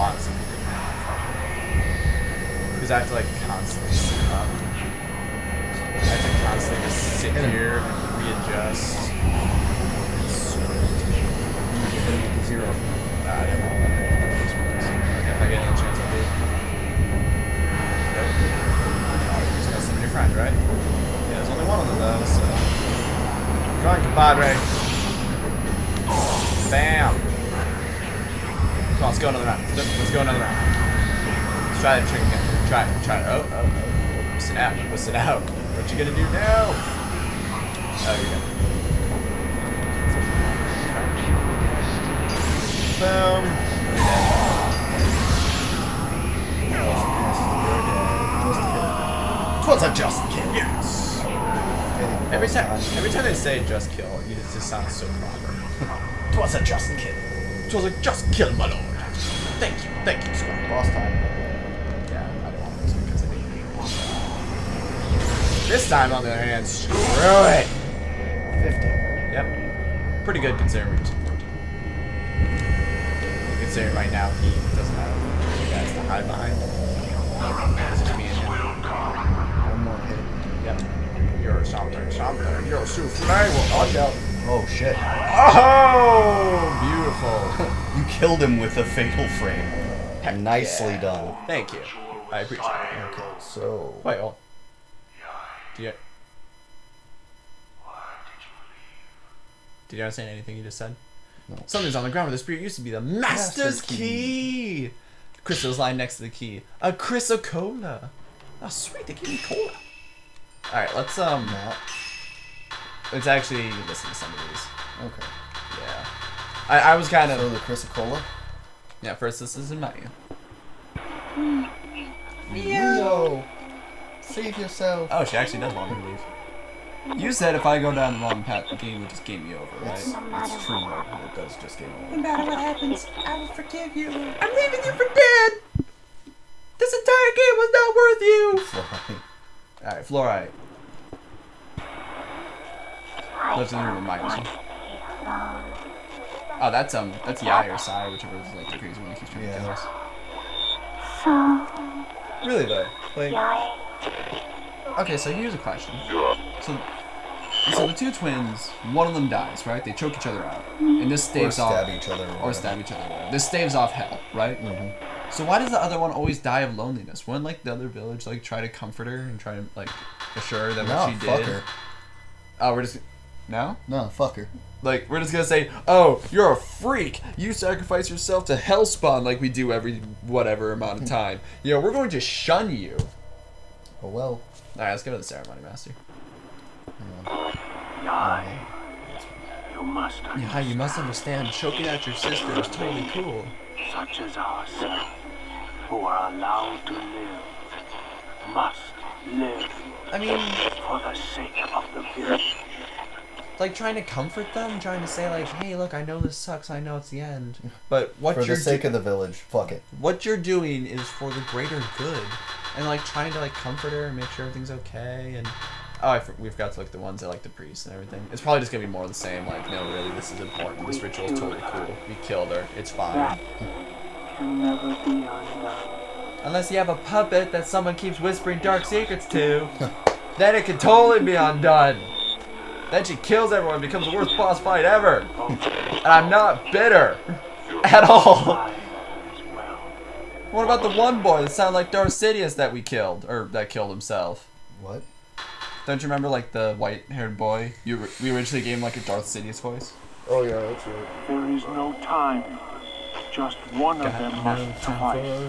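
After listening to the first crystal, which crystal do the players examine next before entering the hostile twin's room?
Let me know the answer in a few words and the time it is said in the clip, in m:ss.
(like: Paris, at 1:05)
Fluorite, at 2:19.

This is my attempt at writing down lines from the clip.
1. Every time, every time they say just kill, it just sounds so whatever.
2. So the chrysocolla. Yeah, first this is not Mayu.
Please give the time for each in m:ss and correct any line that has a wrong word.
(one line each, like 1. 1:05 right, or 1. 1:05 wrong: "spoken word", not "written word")
1. 0:52 wrong: "proper", not "whatever"
2. 1:57 right.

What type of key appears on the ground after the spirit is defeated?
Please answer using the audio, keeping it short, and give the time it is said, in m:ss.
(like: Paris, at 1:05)
Master's key, at 1:42.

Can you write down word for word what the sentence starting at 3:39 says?
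Like, no, really, this is important.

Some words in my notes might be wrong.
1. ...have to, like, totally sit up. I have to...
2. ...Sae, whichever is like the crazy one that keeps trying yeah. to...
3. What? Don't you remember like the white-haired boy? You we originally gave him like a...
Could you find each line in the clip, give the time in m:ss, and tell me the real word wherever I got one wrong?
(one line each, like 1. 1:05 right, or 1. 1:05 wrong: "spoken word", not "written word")
1. 0:02 wrong: "constantly", not "totally"
2. 2:27 right
3. 4:04 right.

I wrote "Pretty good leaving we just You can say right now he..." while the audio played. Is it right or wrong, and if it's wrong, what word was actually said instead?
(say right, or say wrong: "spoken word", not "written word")
wrong: "considering", not "leaving".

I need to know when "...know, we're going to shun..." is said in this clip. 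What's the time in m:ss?
3:01.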